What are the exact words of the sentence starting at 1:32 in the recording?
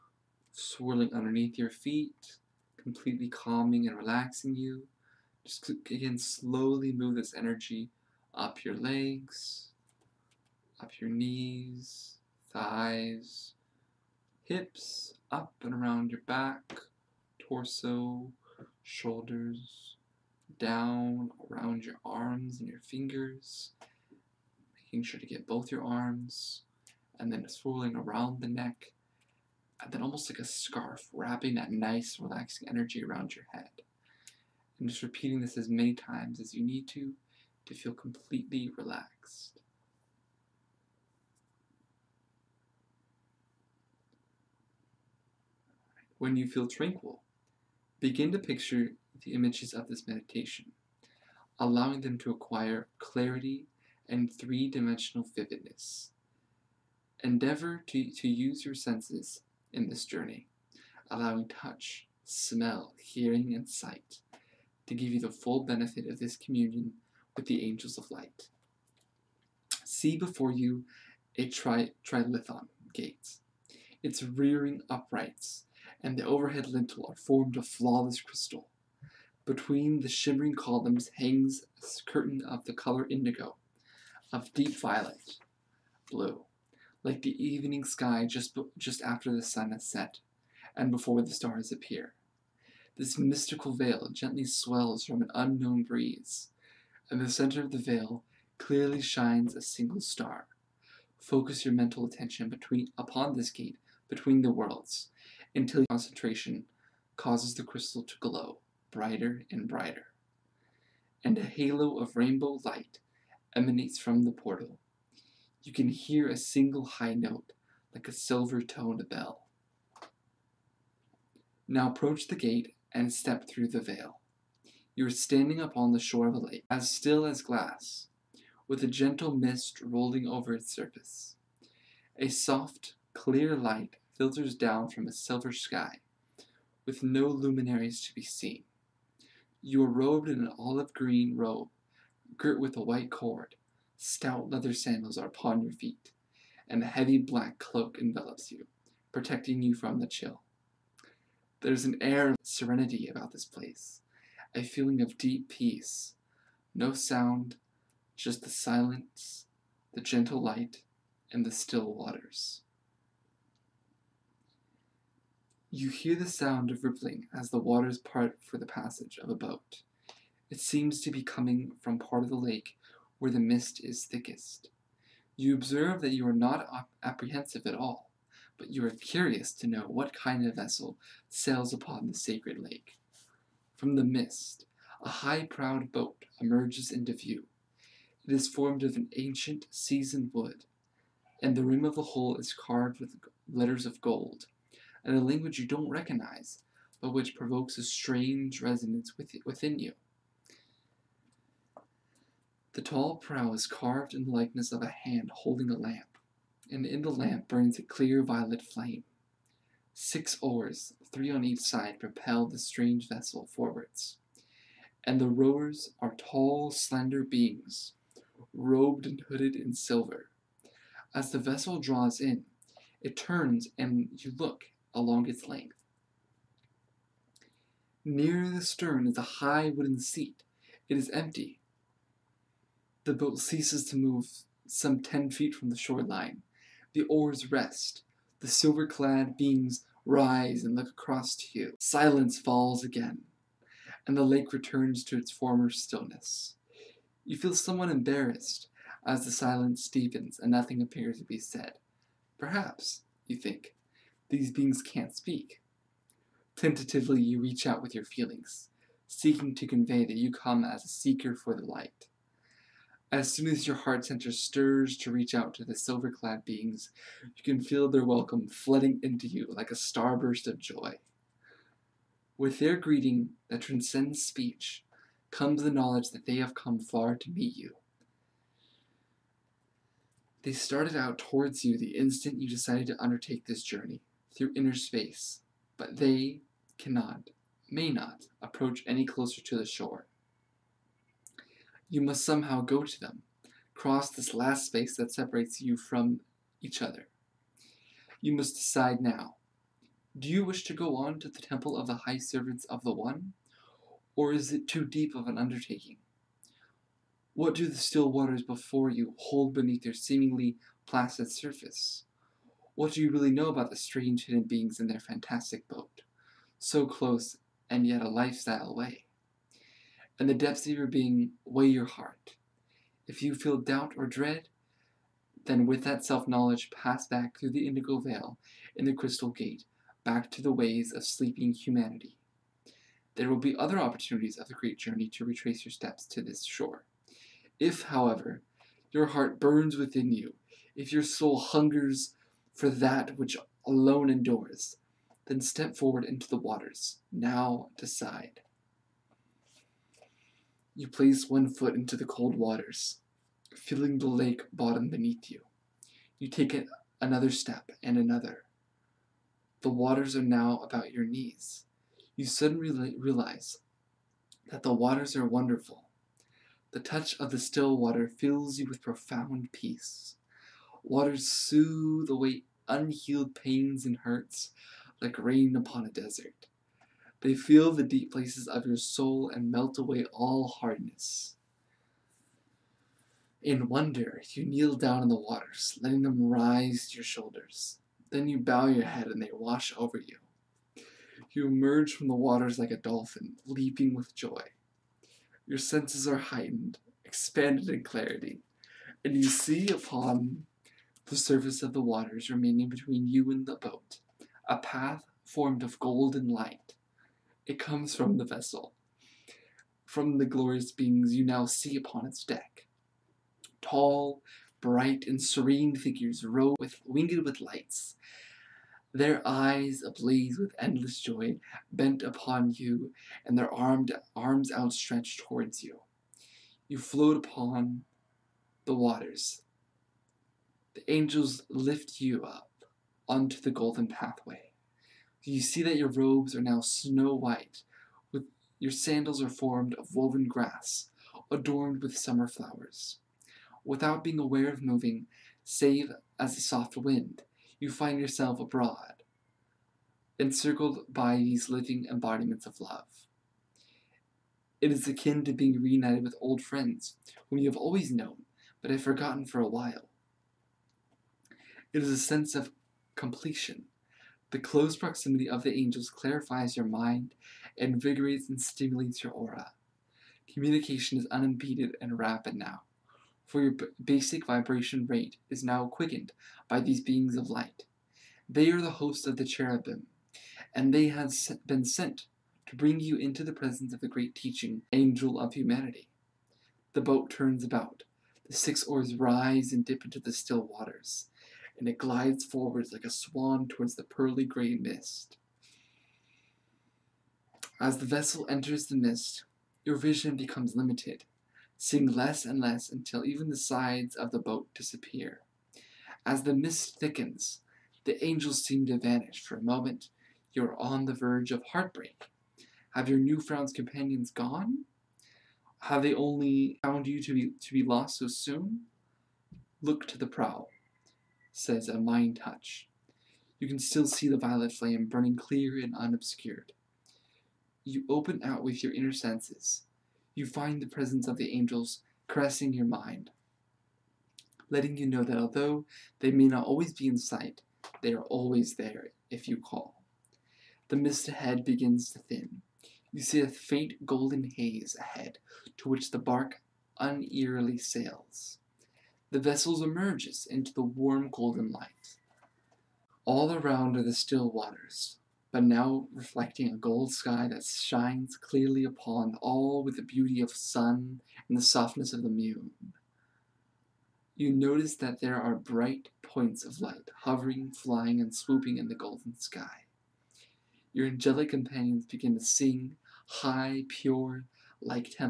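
This mystical veil gently swells from an unknown breeze.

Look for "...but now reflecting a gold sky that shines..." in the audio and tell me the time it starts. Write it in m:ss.
9:15.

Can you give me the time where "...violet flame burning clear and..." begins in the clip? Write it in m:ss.
8:44.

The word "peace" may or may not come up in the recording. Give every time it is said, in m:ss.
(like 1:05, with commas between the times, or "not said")
2:35, 6:09.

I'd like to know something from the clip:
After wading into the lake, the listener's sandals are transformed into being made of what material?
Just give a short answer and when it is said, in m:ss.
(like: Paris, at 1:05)
Woven grass, at 7:19.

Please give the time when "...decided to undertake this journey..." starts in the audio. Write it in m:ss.
4:42.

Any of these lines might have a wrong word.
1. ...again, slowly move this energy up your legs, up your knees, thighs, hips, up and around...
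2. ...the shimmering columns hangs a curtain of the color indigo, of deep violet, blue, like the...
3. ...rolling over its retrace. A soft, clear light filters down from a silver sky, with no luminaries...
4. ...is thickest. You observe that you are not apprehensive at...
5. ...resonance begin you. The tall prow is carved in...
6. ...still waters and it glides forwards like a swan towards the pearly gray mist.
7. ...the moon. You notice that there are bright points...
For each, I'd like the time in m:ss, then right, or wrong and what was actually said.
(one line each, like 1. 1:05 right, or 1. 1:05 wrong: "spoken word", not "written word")
1. 0:05 right
2. 1:20 right
3. 2:09 wrong: "surface", not "retrace"
4. 2:53 right
5. 3:18 wrong: "within", not "begin"
6. 8:10 right
7. 9:22 right.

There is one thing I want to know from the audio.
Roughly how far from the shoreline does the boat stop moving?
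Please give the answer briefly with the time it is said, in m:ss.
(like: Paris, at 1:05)
10 feet, at 3:55.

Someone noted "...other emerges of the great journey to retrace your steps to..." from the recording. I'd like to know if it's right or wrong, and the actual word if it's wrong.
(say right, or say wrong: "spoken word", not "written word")
wrong: "opportunities", not "emerges".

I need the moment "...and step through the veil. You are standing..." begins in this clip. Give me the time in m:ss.
2:02.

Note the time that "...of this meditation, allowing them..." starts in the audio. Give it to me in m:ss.
0:49.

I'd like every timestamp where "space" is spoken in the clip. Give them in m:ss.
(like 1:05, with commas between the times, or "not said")
4:44, 4:54.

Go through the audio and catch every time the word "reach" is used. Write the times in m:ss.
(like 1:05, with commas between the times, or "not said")
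4:17, 4:25.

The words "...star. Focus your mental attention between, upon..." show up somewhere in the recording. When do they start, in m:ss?
1:39.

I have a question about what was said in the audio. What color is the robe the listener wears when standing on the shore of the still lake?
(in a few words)
Olive green.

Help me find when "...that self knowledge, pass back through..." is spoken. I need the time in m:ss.
5:25.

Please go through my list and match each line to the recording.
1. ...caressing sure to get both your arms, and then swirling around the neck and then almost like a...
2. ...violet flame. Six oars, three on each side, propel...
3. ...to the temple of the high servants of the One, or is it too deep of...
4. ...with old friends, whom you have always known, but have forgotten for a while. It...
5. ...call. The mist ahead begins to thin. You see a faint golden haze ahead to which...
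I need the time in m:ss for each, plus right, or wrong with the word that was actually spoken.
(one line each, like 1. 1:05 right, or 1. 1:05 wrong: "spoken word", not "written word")
1. 0:24 wrong: "making", not "caressing"
2. 3:28 right
3. 5:01 right
4. 7:36 right
5. 8:59 right.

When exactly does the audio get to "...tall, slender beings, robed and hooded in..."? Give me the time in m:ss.
3:36.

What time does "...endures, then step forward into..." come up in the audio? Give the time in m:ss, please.
5:44.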